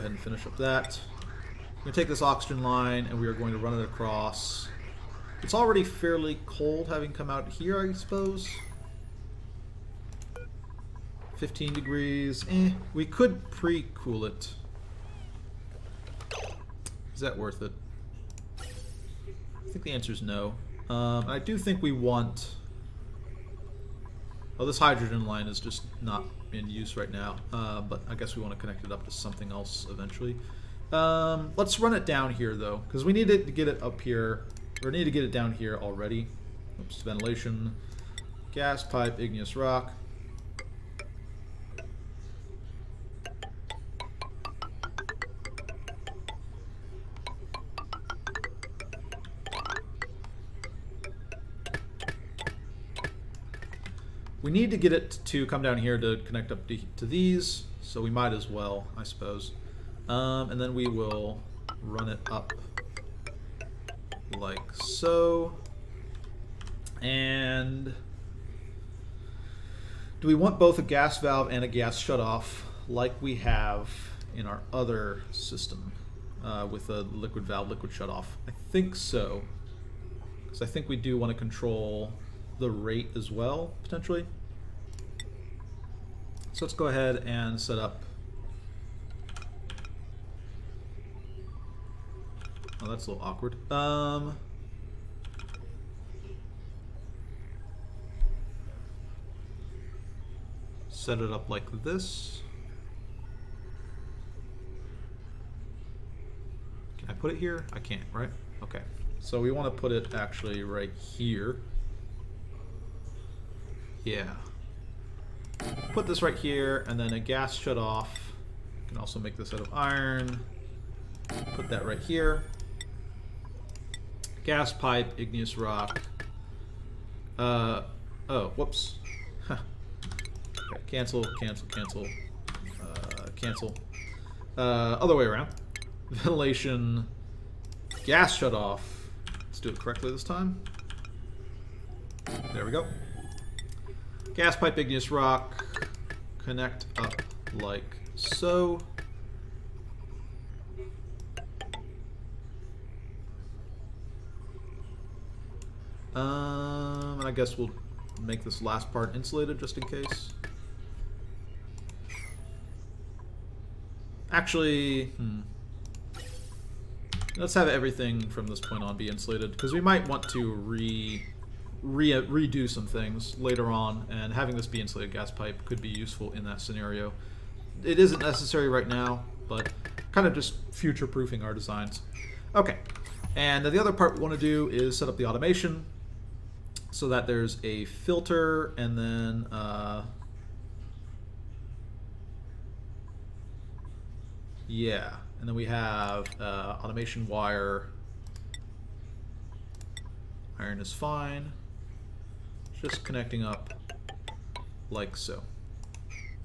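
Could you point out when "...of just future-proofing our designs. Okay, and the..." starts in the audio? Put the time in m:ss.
3:00.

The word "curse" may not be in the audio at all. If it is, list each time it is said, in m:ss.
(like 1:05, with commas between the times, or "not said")
not said.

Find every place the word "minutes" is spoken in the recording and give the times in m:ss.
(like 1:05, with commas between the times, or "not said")
not said.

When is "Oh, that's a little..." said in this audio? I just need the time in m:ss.
1:32.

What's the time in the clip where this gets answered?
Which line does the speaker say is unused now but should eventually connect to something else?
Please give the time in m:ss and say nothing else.
0:24.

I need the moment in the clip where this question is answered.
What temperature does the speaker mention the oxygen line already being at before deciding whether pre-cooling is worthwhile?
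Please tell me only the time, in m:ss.
0:11.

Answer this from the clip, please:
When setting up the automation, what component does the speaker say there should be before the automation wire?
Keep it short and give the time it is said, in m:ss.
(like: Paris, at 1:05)
a filter, at 3:07.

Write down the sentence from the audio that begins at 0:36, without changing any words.
Oops, ventilation, gas pipe, igneous rock.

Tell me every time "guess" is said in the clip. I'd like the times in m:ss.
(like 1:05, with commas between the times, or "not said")
0:28, 2:37.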